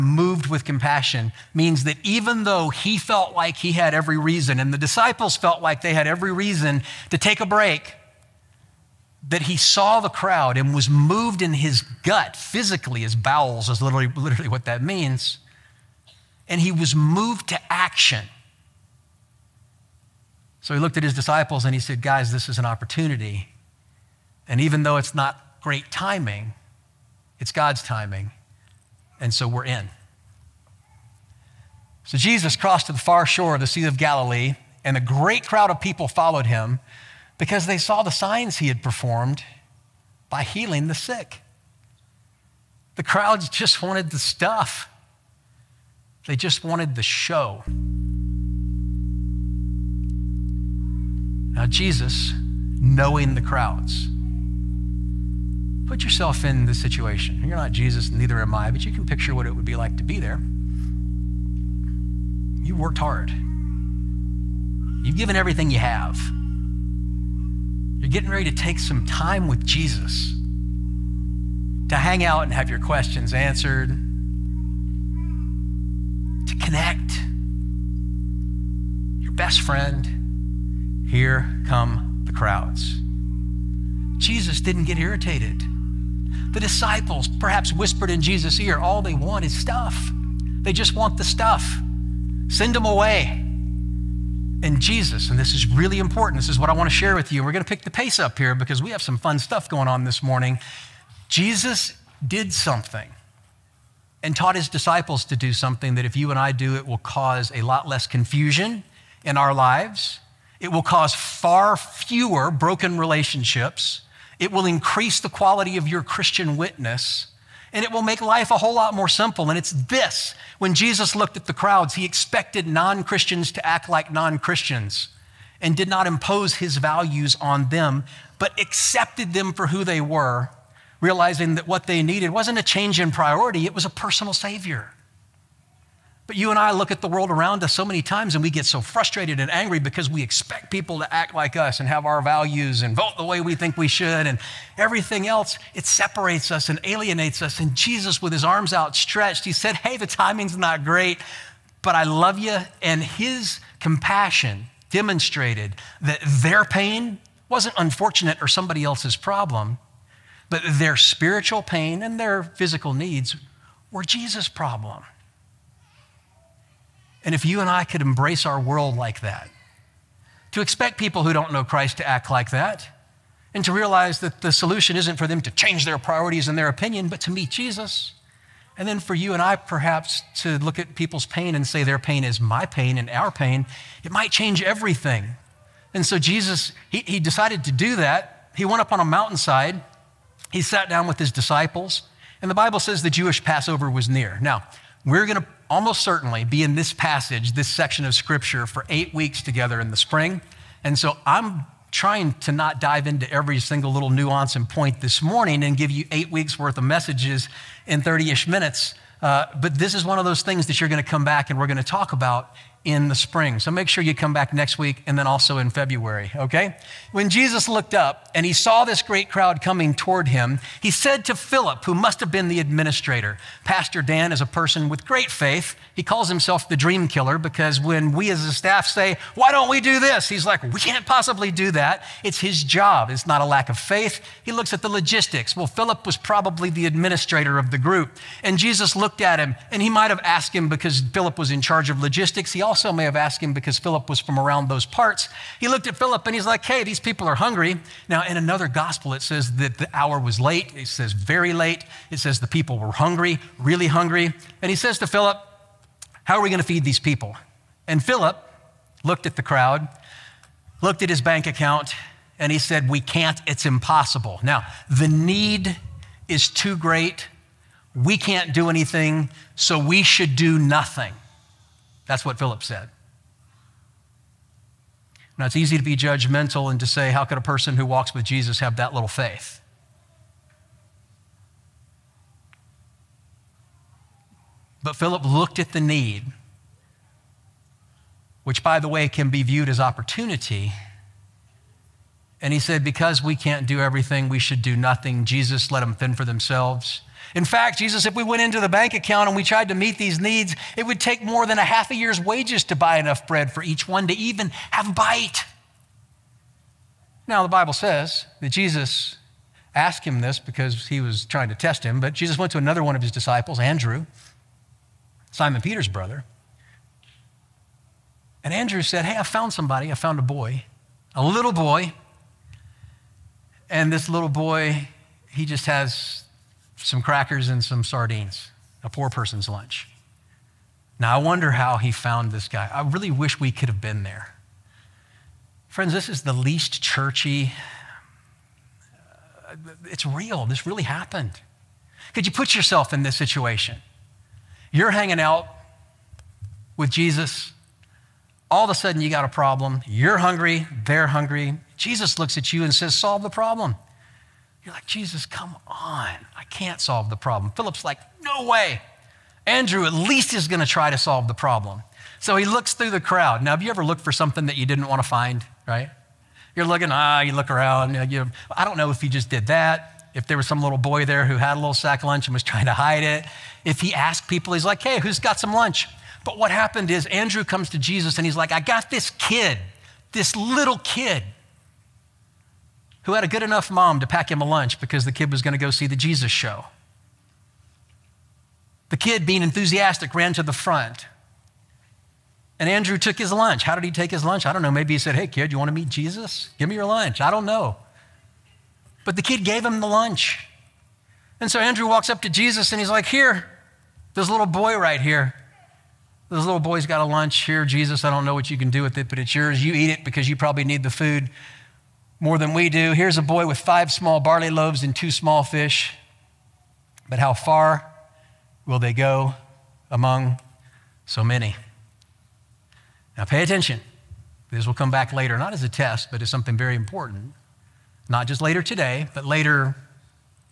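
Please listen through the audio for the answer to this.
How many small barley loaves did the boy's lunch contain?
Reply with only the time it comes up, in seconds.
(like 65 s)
413 s.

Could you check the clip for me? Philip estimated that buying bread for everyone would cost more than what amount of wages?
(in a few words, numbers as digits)
half a year's wages.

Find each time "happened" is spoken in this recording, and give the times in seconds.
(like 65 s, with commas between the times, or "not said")
340 s, 376 s.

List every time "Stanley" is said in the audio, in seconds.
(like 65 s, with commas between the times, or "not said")
not said.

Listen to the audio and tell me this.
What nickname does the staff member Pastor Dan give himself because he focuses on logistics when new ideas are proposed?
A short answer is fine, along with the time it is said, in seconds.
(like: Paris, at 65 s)
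the dream killer, at 226 s.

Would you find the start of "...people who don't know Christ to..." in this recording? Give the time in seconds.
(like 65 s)
170 s.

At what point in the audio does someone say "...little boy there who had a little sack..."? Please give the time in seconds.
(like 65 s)
370 s.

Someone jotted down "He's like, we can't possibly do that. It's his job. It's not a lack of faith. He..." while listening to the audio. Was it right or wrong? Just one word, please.
right.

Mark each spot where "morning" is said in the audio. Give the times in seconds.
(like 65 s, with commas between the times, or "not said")
100 s, 205 s.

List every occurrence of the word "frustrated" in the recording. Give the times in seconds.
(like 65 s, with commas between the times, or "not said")
138 s.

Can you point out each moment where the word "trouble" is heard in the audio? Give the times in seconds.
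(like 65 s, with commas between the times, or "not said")
not said.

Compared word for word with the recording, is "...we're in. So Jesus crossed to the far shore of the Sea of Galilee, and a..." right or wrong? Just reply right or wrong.
right.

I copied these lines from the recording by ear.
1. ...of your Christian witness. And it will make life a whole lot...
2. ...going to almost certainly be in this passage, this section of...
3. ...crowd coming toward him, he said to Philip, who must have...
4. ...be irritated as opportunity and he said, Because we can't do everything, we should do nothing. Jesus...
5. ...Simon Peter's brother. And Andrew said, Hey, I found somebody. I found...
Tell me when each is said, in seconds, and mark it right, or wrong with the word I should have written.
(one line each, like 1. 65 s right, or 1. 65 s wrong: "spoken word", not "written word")
1. 115 s right
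2. 195 s right
3. 219 s right
4. 289 s wrong: "viewed", not "irritated"
5. 315 s right.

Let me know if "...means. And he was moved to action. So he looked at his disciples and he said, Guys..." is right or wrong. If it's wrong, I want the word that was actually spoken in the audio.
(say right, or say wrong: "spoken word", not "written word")
right.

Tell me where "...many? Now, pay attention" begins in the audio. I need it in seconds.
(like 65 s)
421 s.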